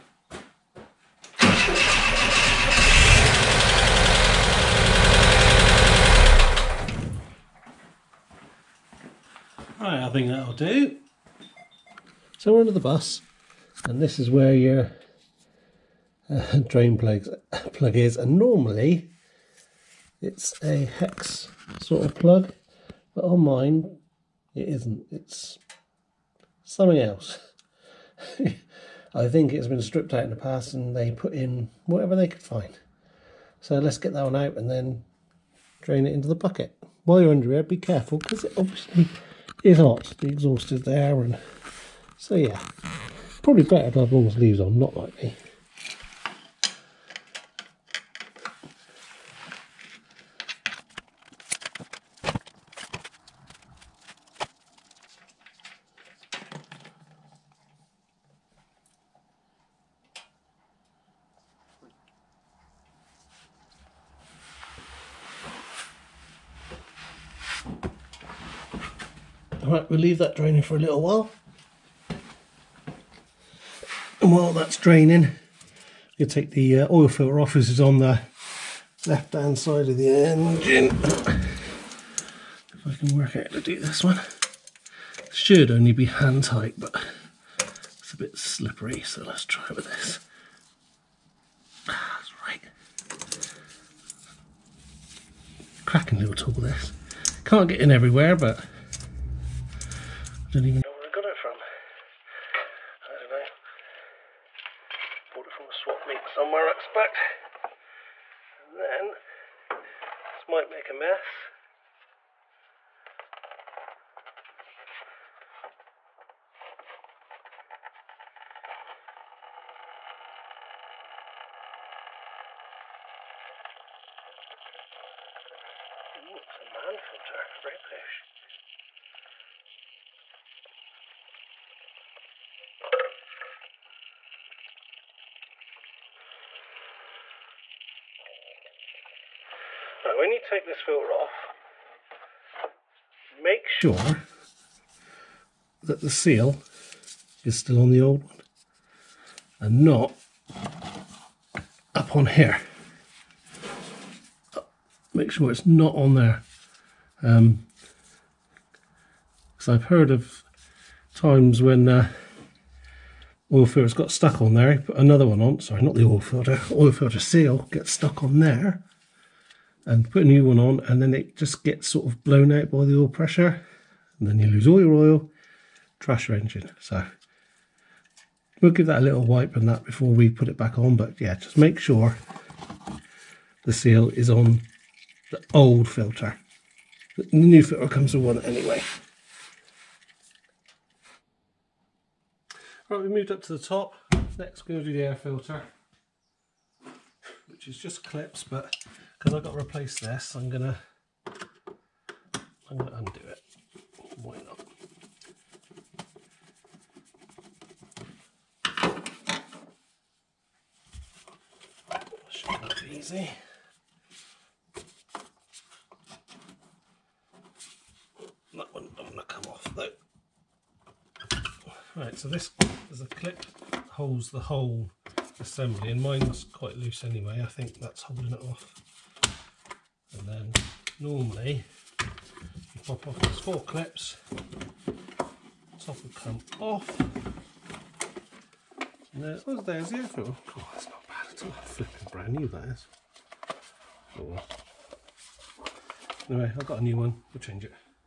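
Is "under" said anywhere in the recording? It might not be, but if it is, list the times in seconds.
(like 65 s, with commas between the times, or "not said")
12 s, 37 s.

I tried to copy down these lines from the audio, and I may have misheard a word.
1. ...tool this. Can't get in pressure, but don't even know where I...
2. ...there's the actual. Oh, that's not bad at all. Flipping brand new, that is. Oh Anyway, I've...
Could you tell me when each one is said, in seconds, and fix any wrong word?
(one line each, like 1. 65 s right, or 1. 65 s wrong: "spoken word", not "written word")
1. 96 s wrong: "everywhere", not "pressure"
2. 239 s right.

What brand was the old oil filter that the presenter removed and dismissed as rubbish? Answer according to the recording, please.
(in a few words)
Mann.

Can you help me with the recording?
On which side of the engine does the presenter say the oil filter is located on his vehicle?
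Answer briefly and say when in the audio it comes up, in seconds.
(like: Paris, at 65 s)
Left hand side, at 79 s.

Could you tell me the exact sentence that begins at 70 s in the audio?
leave that draining for a little while.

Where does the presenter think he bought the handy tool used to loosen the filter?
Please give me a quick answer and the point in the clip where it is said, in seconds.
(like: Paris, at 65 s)
A swap meet, at 105 s.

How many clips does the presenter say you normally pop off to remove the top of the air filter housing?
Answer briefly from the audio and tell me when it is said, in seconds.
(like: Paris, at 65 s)
4, at 233 s.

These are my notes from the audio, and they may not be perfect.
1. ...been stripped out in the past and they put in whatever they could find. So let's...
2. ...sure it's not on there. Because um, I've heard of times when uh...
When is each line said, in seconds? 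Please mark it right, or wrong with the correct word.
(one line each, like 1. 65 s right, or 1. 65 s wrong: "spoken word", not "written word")
1. 29 s right
2. 155 s right.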